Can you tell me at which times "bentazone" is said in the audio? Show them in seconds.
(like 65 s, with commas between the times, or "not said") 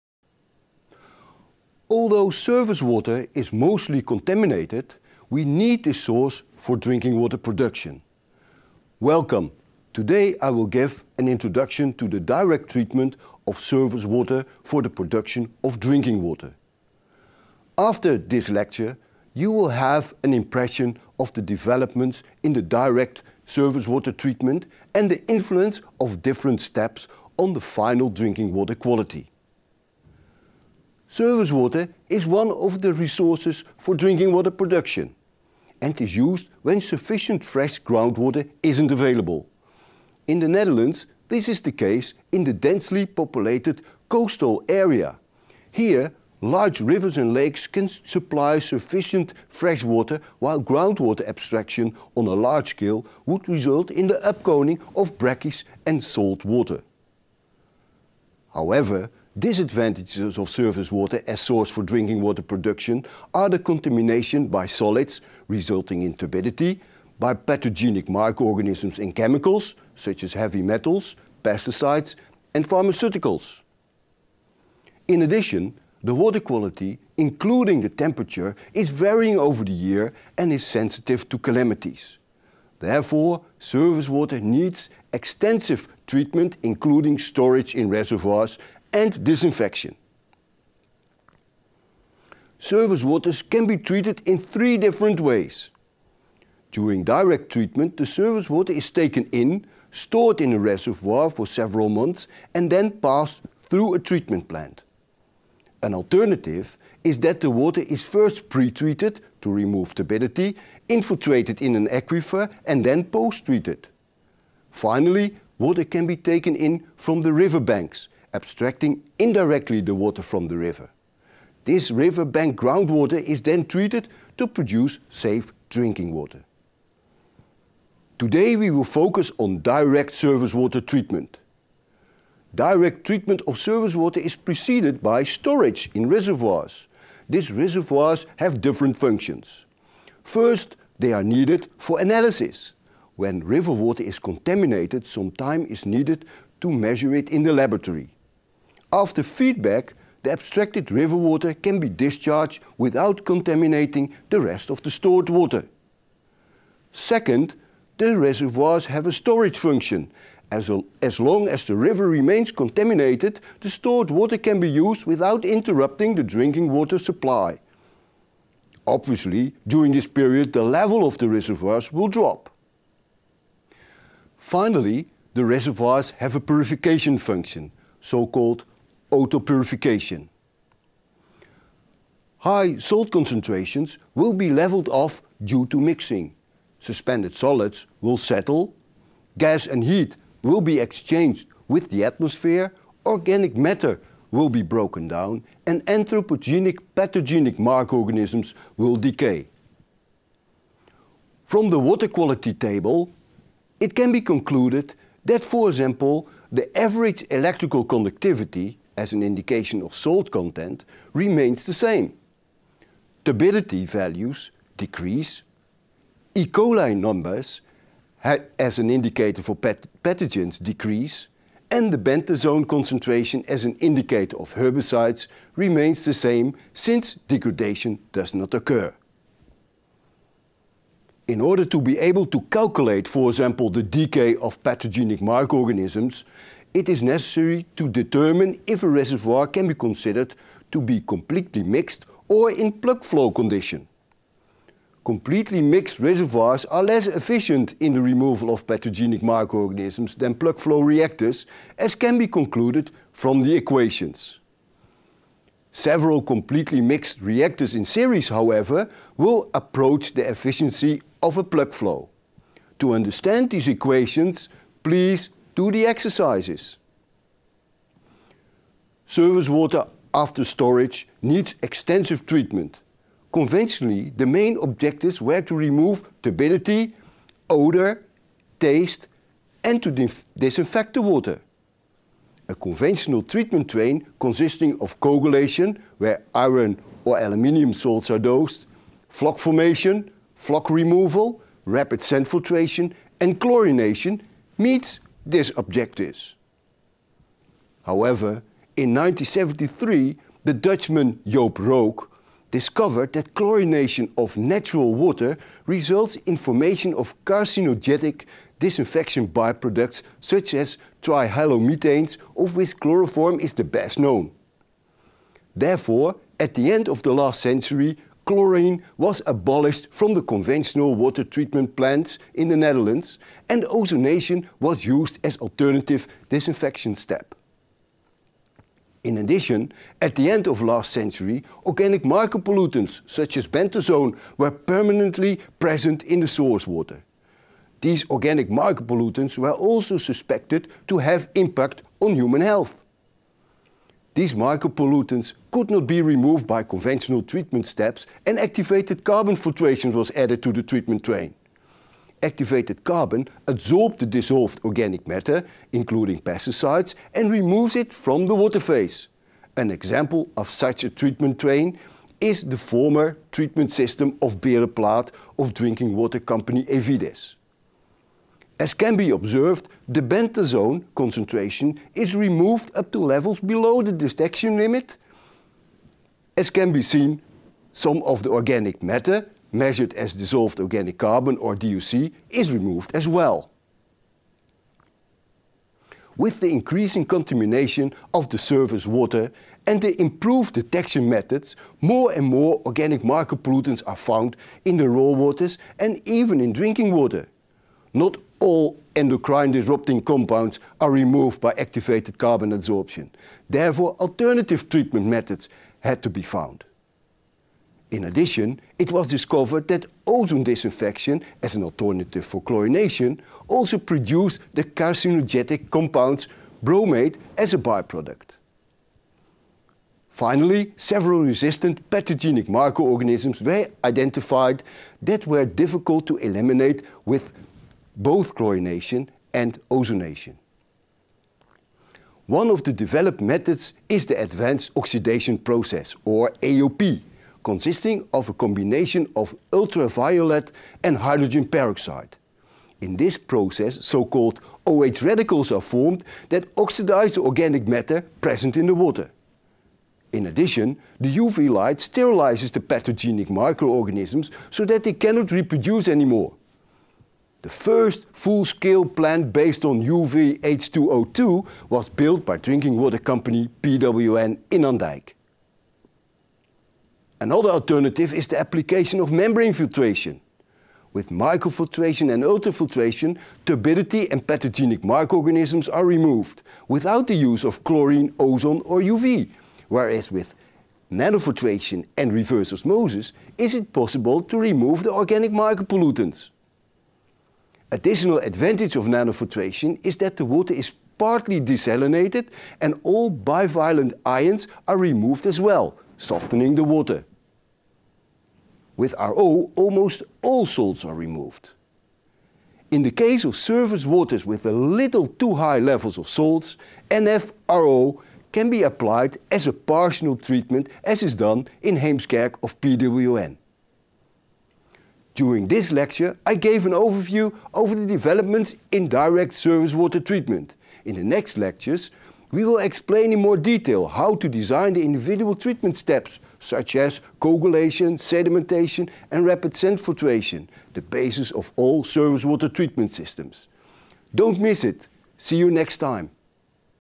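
221 s, 333 s, 370 s.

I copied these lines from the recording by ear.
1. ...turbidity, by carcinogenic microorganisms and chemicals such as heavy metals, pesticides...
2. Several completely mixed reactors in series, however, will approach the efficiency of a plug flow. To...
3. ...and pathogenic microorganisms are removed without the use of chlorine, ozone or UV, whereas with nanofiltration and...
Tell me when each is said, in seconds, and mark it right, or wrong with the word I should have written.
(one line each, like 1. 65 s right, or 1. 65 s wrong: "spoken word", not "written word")
1. 66 s wrong: "pathogenic", not "carcinogenic"
2. 255 s right
3. 474 s right.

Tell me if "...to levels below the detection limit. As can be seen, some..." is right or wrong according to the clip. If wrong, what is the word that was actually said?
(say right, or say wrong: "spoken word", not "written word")
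right.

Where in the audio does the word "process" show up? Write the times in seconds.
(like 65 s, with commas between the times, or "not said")
435 s, 443 s.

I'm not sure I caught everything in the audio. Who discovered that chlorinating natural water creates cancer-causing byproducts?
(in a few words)
Joop Rook.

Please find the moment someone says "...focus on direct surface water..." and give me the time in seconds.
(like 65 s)
128 s.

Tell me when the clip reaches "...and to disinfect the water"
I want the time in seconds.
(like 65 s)
279 s.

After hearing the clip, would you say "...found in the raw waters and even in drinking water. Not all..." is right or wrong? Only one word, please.
right.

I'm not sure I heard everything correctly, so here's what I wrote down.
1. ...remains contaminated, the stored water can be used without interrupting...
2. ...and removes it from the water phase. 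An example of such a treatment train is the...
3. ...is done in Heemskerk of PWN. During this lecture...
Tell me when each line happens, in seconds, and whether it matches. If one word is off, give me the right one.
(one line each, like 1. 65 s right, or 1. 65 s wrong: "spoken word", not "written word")
1. 162 s right
2. 357 s right
3. 511 s right.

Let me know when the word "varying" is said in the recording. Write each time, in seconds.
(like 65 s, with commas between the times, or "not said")
78 s.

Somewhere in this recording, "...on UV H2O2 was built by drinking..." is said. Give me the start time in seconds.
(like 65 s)
459 s.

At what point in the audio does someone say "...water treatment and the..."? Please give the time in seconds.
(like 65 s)
23 s.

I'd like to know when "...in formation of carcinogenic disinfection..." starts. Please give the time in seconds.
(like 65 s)
306 s.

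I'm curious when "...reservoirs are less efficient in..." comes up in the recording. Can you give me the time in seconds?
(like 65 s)
245 s.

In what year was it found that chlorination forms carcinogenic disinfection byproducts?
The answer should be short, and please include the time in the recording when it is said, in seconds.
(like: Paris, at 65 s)
1973, at 298 s.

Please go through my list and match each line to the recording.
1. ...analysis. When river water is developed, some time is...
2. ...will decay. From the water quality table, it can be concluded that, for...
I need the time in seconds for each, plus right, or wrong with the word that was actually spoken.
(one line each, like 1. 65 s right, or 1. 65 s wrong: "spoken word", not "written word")
1. 141 s wrong: "contaminated", not "developed"
2. 198 s right.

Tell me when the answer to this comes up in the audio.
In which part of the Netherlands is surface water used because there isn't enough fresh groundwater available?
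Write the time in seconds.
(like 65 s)
42 s.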